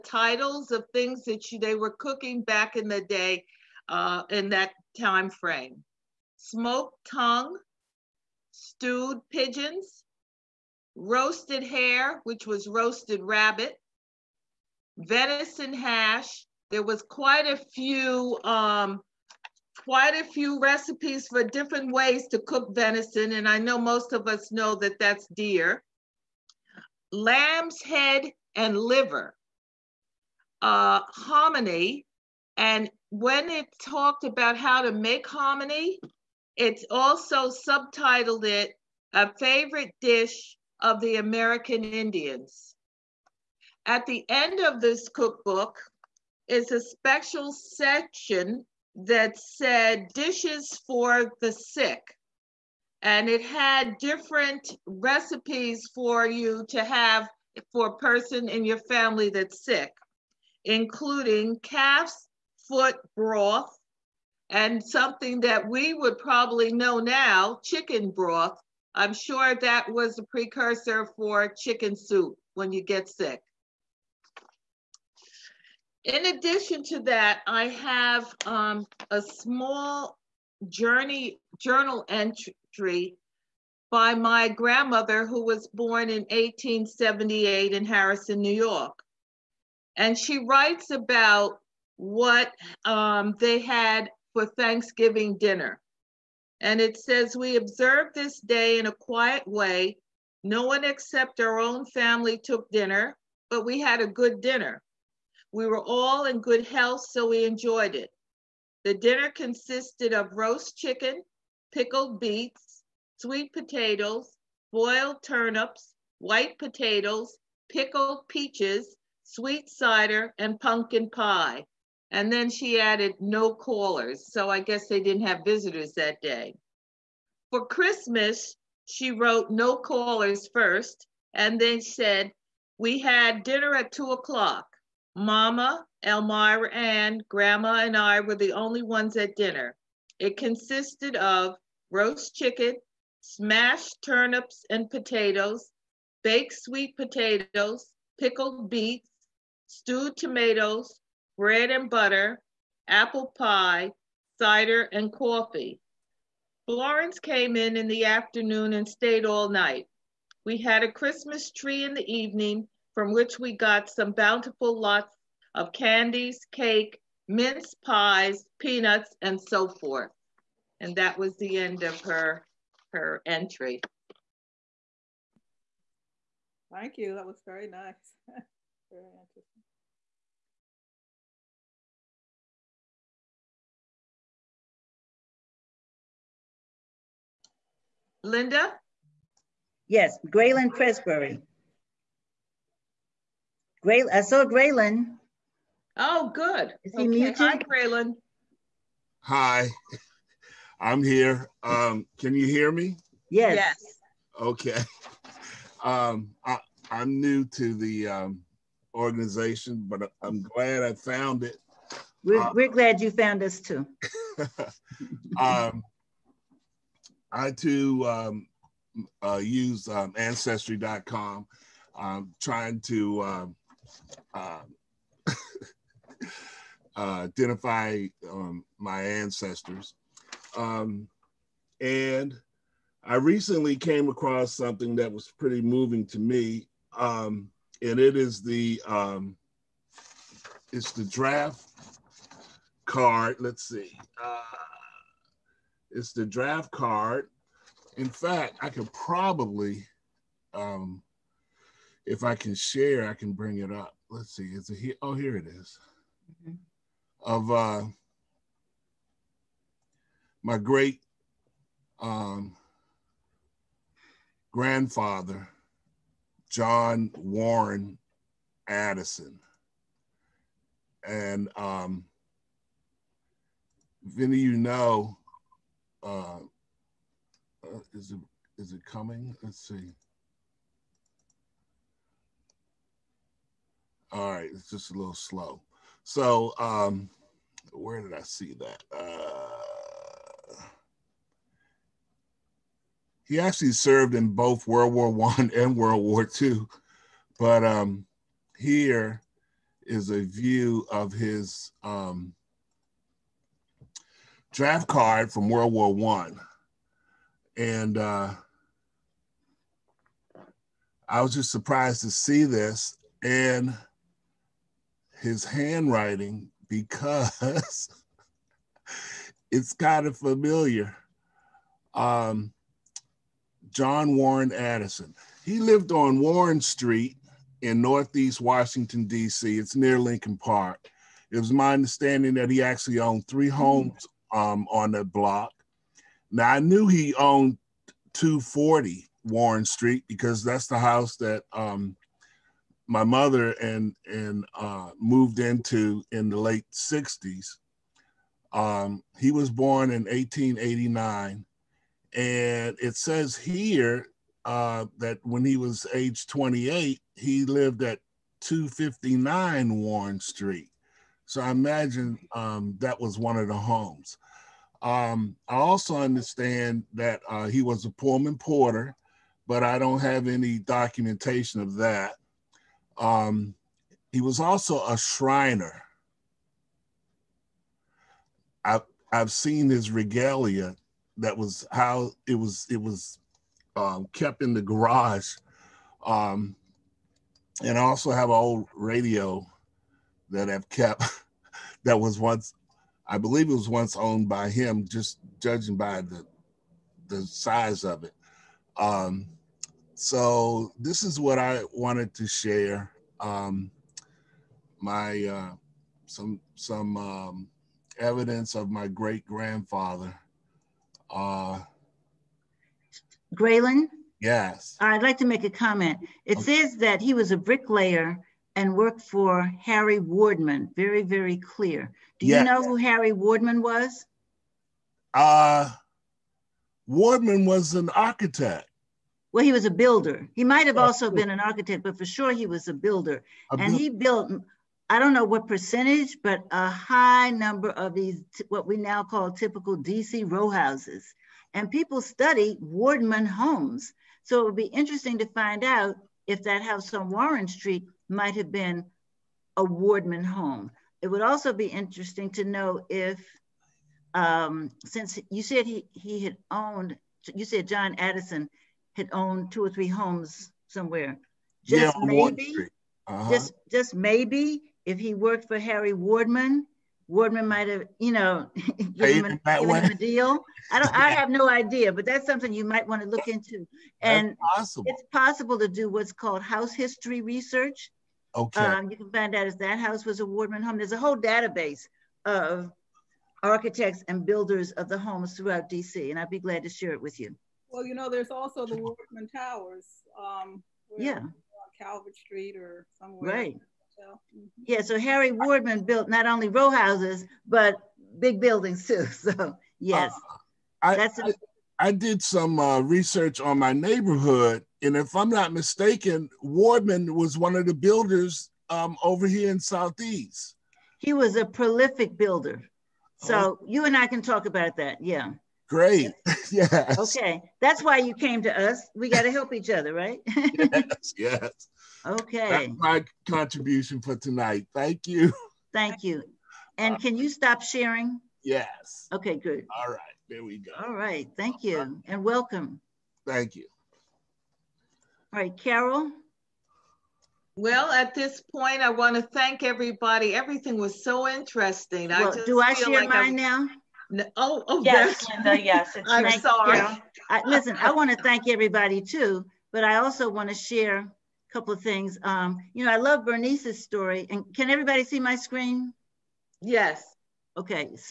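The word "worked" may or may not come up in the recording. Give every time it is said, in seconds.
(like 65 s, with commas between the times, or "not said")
418 s, 465 s.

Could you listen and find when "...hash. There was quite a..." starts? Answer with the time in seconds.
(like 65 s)
15 s.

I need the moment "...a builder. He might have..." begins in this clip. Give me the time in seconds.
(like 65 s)
429 s.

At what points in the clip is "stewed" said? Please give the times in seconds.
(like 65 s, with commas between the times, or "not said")
8 s, 149 s.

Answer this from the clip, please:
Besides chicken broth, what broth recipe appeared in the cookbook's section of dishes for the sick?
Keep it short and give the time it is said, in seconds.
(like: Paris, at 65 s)
calf's foot broth, at 61 s.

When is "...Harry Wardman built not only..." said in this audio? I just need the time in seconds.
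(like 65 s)
494 s.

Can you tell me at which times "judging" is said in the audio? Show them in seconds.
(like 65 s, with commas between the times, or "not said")
395 s.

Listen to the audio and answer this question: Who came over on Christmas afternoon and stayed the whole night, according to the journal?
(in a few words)
Florence.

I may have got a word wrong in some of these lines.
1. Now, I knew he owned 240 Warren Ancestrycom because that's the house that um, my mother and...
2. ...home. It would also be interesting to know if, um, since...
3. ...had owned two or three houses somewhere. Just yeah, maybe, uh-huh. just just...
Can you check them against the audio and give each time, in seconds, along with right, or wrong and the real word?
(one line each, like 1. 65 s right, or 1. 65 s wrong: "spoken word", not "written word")
1. 336 s wrong: "Street", not "Ancestrycom"
2. 450 s right
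3. 458 s wrong: "homes", not "houses".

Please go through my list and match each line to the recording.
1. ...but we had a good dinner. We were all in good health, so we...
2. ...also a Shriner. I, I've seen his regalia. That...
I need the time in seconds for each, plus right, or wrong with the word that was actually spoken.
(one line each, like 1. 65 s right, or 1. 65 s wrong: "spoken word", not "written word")
1. 103 s right
2. 374 s right.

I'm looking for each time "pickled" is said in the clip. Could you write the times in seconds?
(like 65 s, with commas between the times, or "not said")
111 s, 117 s, 148 s.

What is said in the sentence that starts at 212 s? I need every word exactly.
We're, uh, we're glad you found us too.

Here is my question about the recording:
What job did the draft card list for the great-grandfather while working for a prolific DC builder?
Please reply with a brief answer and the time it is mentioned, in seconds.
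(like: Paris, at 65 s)
bricklayer, at 417 s.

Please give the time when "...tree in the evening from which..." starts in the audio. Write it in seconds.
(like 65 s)
161 s.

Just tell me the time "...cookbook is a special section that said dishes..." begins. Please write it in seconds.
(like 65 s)
45 s.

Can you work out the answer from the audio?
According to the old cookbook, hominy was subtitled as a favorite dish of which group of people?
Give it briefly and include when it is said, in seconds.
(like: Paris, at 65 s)
American Indians, at 41 s.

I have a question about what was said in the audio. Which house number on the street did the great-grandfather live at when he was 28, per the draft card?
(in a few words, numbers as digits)
259.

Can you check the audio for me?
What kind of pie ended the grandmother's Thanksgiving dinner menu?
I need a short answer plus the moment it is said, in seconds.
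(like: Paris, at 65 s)
pumpkin pie, at 120 s.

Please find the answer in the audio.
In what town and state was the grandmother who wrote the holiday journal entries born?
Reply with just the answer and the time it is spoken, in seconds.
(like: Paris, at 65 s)
Harrison, New York, at 87 s.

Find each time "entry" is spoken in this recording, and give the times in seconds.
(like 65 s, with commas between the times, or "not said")
82 s, 173 s.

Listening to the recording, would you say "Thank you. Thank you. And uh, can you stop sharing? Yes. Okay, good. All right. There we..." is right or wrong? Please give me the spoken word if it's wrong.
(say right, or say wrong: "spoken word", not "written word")
right.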